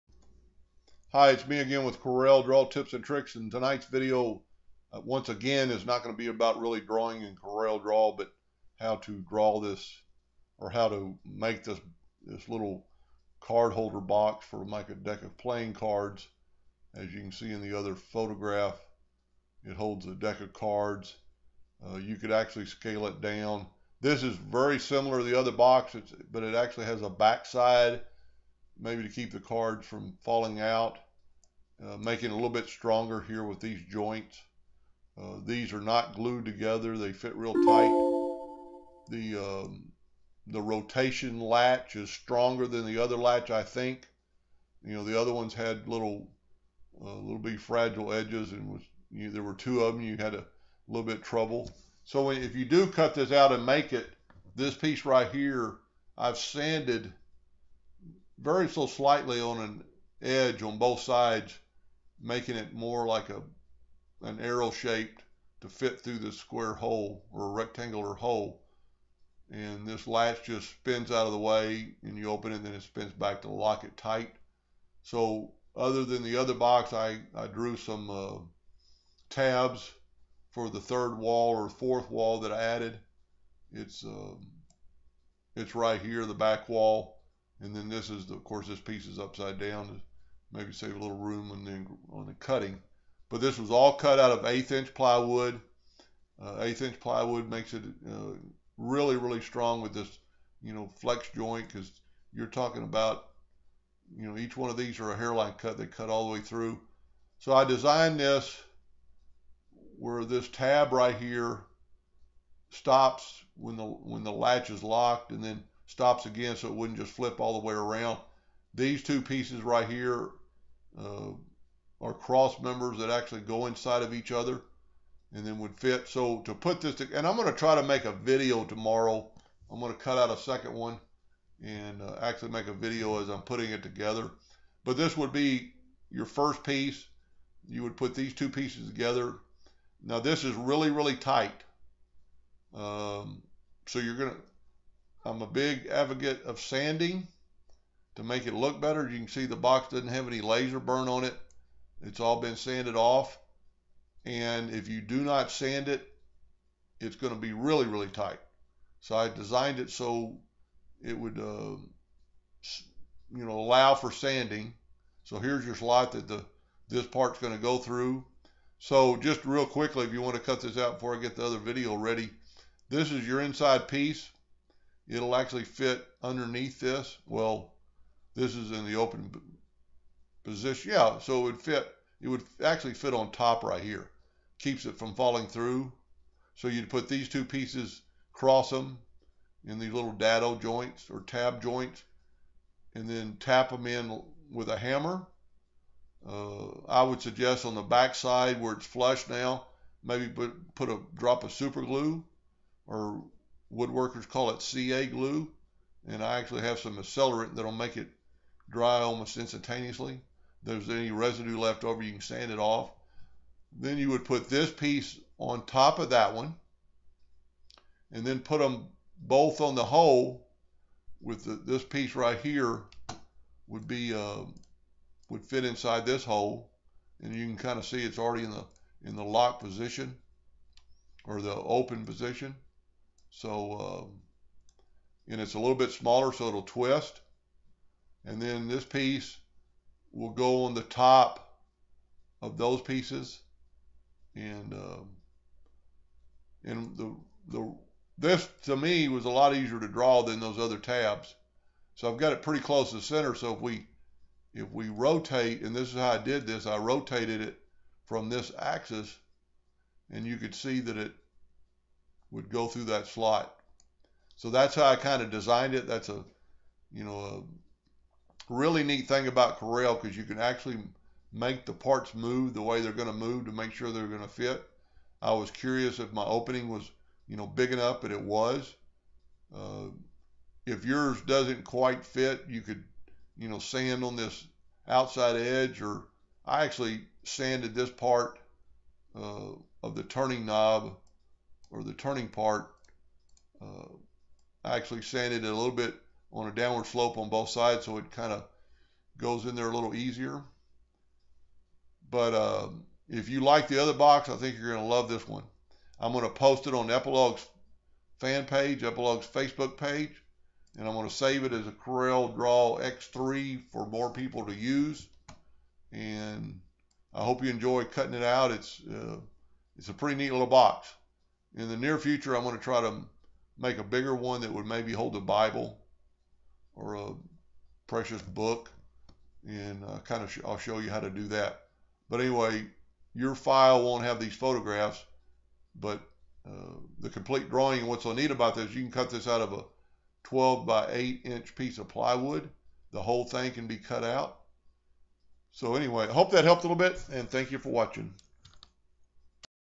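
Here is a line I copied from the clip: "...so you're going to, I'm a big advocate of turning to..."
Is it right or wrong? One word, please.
wrong.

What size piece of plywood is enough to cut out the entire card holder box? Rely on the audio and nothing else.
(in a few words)
12 by 8 inch.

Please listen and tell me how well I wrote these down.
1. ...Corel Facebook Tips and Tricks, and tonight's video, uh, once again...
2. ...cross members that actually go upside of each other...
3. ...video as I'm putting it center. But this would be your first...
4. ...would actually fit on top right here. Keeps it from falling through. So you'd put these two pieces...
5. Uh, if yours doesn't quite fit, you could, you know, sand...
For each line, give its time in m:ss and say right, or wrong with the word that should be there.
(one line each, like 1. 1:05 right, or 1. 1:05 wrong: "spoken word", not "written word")
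1. 0:01 wrong: "Draw", not "Facebook"
2. 2:02 wrong: "inside", not "upside"
3. 2:12 wrong: "together", not "center"
4. 3:02 right
5. 4:39 right.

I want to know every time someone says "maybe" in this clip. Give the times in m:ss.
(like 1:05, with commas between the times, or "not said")
0:28, 1:30, 3:20, 5:24.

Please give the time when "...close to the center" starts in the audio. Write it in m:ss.
4:12.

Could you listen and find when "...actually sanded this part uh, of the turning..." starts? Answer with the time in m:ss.
4:46.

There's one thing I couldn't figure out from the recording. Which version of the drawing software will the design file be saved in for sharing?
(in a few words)
Corel Draw X3.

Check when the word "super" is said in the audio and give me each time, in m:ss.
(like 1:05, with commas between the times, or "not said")
3:21.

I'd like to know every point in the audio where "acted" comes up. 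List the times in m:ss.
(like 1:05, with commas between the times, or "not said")
not said.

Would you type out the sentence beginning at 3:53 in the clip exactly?
So, um, and it's a little bit smaller, so it'll twist.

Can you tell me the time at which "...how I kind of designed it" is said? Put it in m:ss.
4:24.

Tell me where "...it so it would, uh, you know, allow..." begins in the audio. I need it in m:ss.
2:39.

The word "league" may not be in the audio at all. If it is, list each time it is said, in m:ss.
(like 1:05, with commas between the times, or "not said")
not said.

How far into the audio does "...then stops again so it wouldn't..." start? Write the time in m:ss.
1:55.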